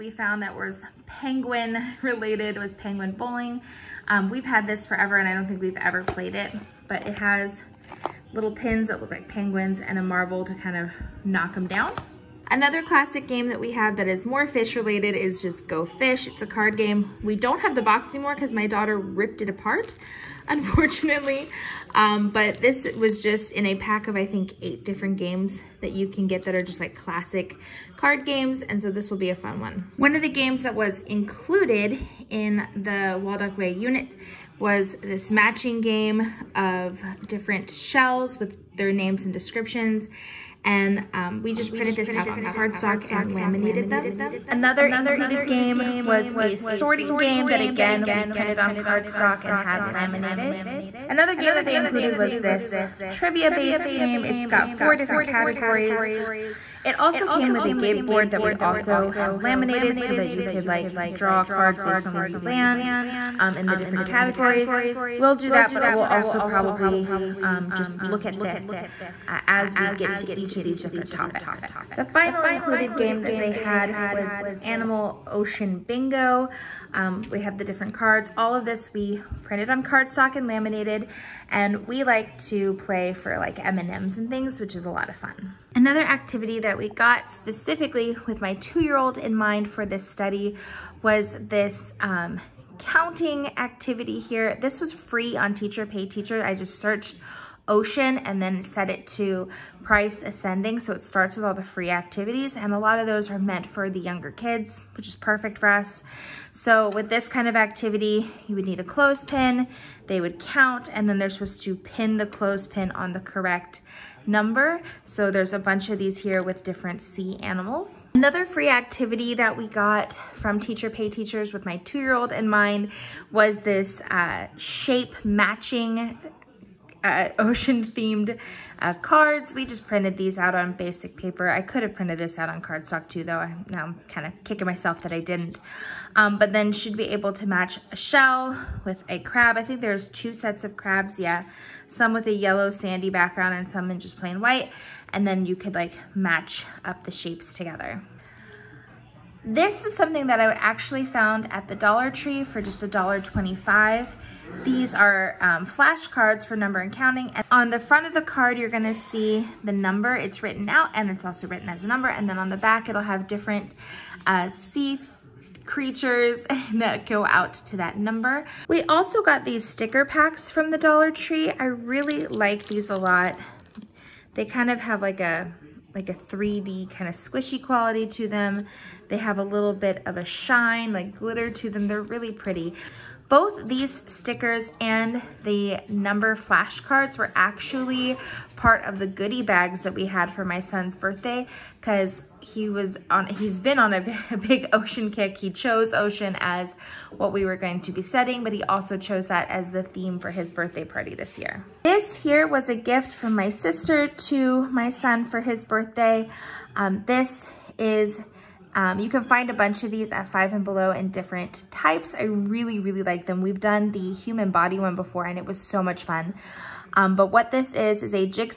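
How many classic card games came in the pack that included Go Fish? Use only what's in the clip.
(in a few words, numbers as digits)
8.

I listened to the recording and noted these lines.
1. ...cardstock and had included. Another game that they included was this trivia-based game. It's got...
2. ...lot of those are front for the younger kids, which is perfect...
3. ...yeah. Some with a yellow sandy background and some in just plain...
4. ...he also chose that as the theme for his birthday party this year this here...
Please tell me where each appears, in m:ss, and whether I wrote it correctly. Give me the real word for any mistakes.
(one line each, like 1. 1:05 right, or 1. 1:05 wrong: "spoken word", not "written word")
1. 0:48 wrong: "laminated", not "included"
2. 1:42 wrong: "meant", not "front"
3. 2:21 right
4. 3:18 right.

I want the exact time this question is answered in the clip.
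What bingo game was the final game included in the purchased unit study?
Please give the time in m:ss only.
1:14.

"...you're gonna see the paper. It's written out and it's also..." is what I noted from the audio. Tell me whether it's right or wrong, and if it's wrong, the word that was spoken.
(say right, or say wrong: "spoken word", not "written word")
wrong: "number", not "paper".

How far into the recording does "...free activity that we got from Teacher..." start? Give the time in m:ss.
1:58.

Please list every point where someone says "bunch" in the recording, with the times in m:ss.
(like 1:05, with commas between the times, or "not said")
1:55, 3:29.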